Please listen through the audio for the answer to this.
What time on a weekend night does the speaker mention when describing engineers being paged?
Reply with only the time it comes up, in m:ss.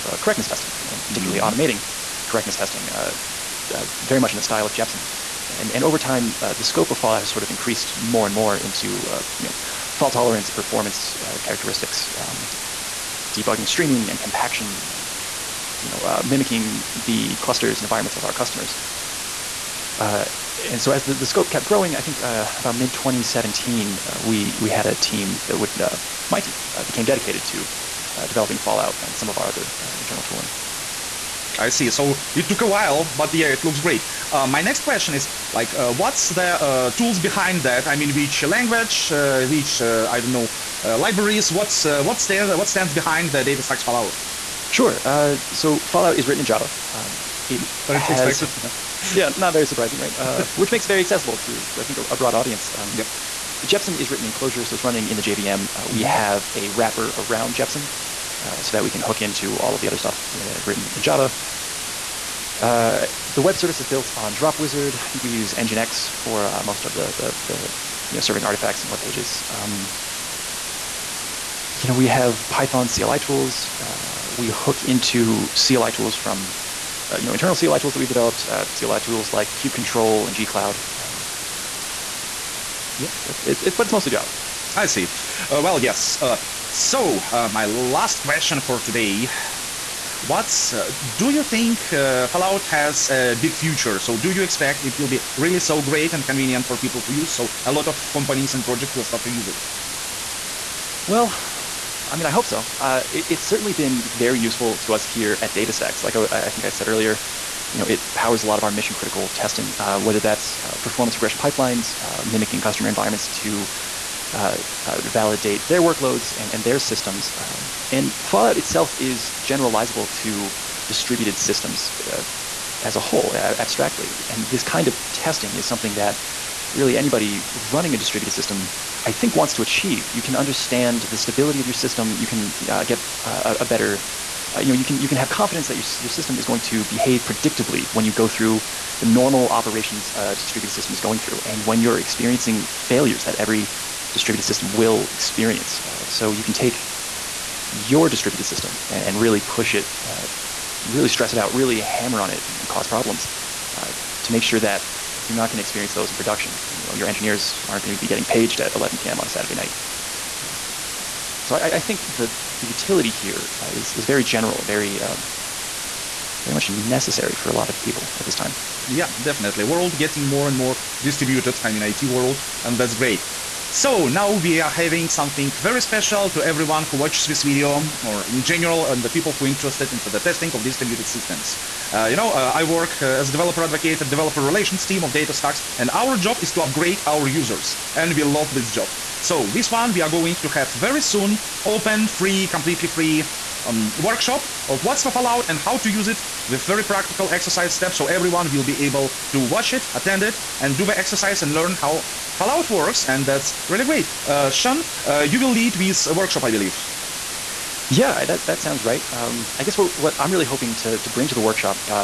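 2:38.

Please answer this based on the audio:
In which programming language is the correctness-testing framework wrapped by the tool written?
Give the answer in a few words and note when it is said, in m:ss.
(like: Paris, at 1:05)
Clojure, at 0:54.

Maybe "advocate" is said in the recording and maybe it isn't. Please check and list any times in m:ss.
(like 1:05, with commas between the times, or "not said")
3:03.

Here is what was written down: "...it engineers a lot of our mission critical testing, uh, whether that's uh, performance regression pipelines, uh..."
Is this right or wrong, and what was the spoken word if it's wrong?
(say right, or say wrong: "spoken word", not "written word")
wrong: "powers", not "engineers".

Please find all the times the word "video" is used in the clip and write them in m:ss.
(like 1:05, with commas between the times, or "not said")
2:57.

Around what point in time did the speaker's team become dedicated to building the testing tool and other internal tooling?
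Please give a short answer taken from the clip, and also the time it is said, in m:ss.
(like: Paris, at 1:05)
mid 2017, at 0:22.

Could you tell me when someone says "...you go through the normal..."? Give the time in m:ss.
2:18.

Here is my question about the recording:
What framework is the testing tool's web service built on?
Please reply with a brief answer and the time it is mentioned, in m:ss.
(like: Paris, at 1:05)
DropWizard, at 1:04.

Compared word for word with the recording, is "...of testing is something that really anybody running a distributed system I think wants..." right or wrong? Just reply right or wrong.
right.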